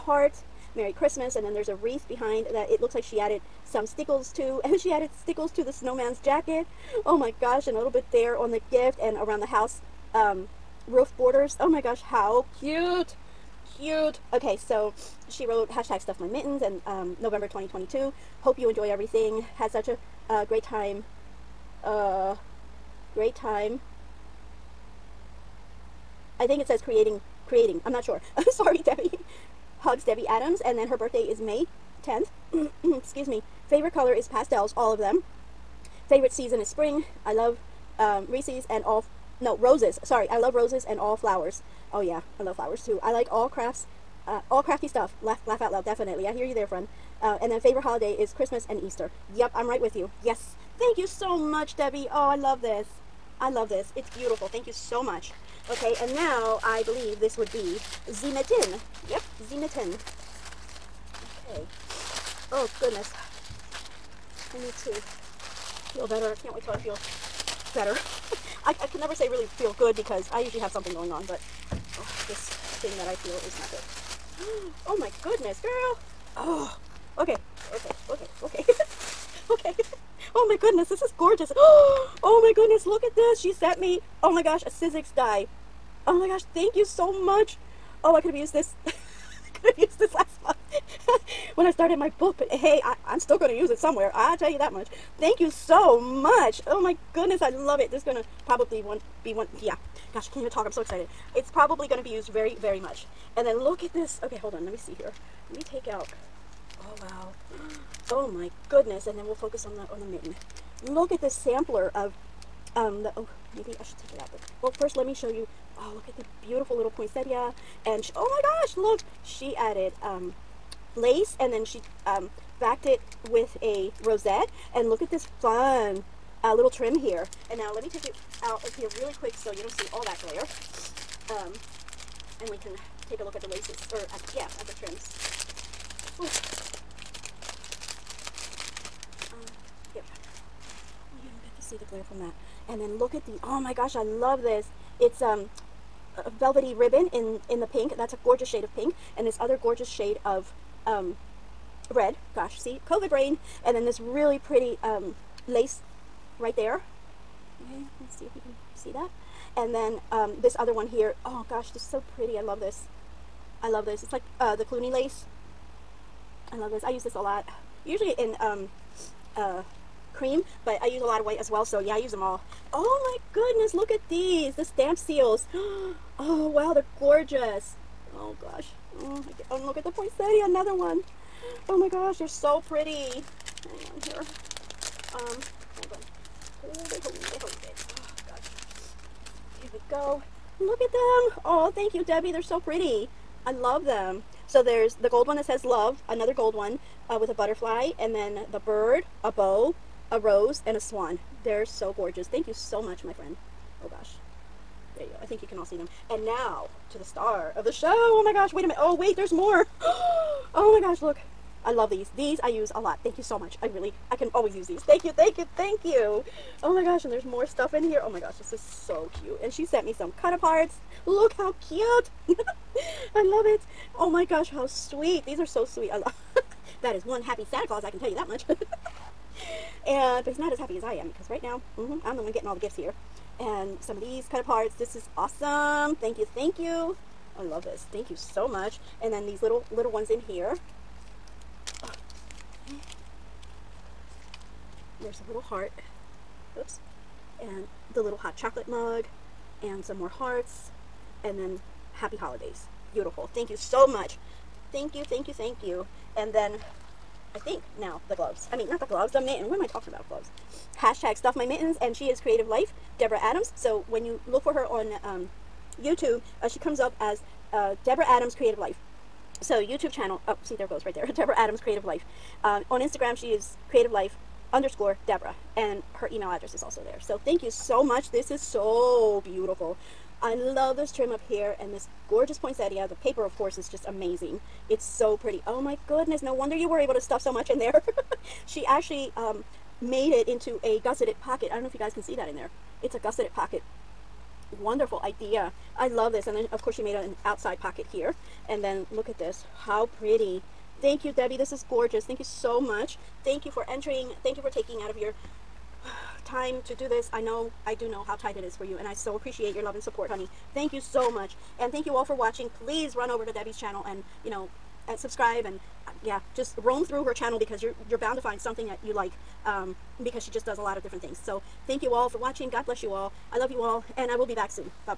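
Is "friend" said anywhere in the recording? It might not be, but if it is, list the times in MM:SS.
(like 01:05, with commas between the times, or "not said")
00:46, 03:23.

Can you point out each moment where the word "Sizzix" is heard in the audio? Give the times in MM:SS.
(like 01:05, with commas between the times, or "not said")
01:24.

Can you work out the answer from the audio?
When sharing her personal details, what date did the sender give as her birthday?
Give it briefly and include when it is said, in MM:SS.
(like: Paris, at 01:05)
May 10th, at 00:31.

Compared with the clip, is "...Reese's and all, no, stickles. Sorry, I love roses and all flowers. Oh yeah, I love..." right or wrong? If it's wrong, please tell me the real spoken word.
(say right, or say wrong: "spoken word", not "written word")
wrong: "roses", not "stickles".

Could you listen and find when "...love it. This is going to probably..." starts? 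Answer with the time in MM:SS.
01:37.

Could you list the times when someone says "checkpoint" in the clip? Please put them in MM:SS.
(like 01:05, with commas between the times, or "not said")
not said.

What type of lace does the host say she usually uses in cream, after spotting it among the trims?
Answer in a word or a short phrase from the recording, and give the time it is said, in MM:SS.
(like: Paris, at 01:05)
Cluny lace, at 02:44.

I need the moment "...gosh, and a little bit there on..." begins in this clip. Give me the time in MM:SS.
00:07.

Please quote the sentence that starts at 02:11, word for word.
Um, and we can take a look at the laces, or at, yeah, at the trims.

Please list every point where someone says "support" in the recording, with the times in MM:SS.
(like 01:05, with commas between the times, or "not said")
05:09.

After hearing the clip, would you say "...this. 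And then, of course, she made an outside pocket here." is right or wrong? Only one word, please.
right.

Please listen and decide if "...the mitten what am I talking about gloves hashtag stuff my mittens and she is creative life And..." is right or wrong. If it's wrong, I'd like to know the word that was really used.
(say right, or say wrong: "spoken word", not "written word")
wrong: "Deborah", not "And".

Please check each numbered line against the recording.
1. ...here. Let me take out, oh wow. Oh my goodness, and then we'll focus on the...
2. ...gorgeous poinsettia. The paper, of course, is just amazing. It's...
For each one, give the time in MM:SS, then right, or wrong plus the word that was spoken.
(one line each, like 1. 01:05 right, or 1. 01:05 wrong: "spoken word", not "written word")
1. 01:44 right
2. 04:42 right.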